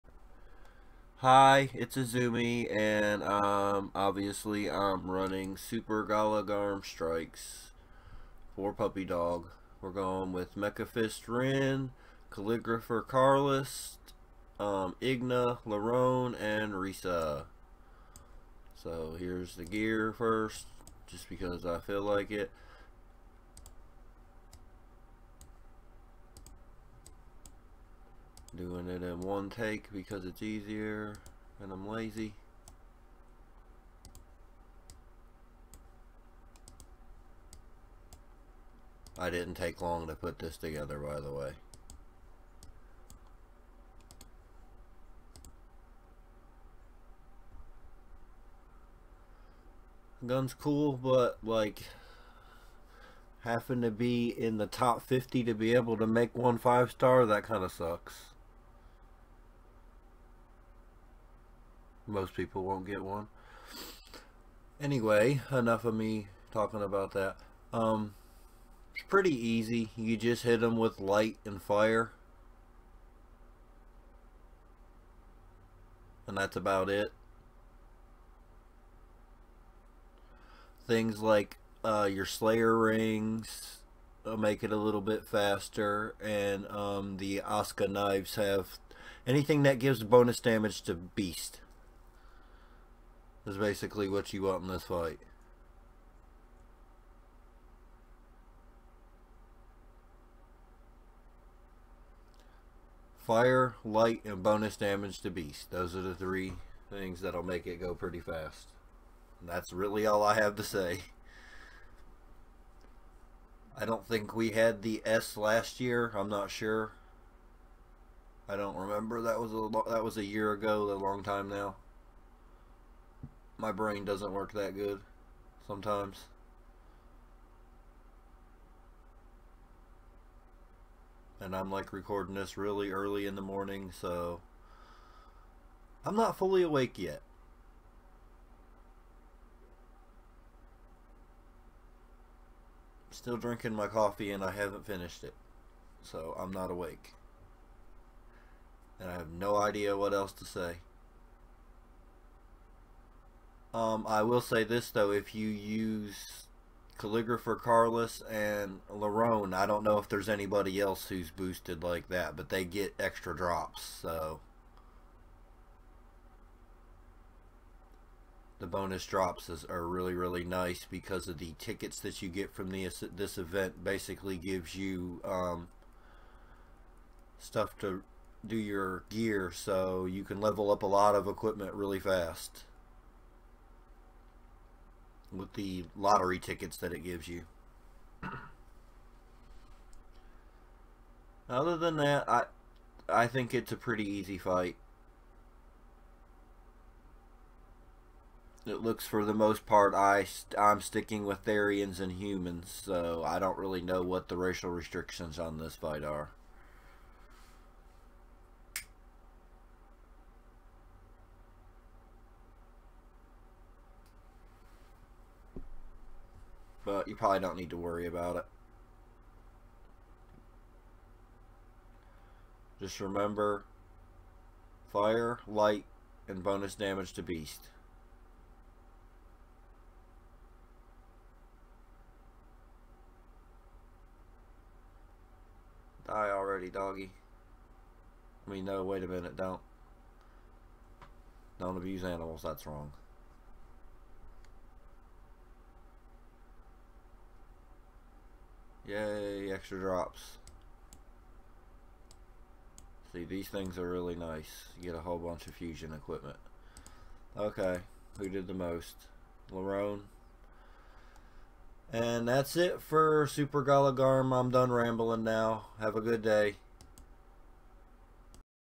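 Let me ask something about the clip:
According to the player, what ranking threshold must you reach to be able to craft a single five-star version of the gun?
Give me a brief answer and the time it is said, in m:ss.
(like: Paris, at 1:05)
Top 50, at 0:54.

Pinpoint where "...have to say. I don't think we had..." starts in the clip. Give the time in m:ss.
1:50.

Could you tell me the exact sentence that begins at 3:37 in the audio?
you probably don't need to worry about it.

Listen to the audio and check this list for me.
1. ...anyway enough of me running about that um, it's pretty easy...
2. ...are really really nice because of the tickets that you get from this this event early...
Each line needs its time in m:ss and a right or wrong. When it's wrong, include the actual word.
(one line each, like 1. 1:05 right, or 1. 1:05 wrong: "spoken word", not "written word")
1. 1:04 wrong: "talking", not "running"
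2. 2:49 wrong: "basically", not "early".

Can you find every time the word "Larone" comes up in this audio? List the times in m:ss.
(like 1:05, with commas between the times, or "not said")
0:15, 2:38, 4:19.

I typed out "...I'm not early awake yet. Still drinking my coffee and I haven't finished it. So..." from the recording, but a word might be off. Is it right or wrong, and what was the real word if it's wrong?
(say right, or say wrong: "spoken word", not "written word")
wrong: "fully", not "early".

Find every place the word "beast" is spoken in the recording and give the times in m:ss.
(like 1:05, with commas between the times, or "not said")
1:30, 1:45, 3:47.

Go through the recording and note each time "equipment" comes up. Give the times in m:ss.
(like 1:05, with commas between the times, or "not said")
3:01, 4:15.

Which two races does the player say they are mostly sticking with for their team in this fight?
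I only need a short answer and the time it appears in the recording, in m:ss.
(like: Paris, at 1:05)
Therians and humans, at 3:21.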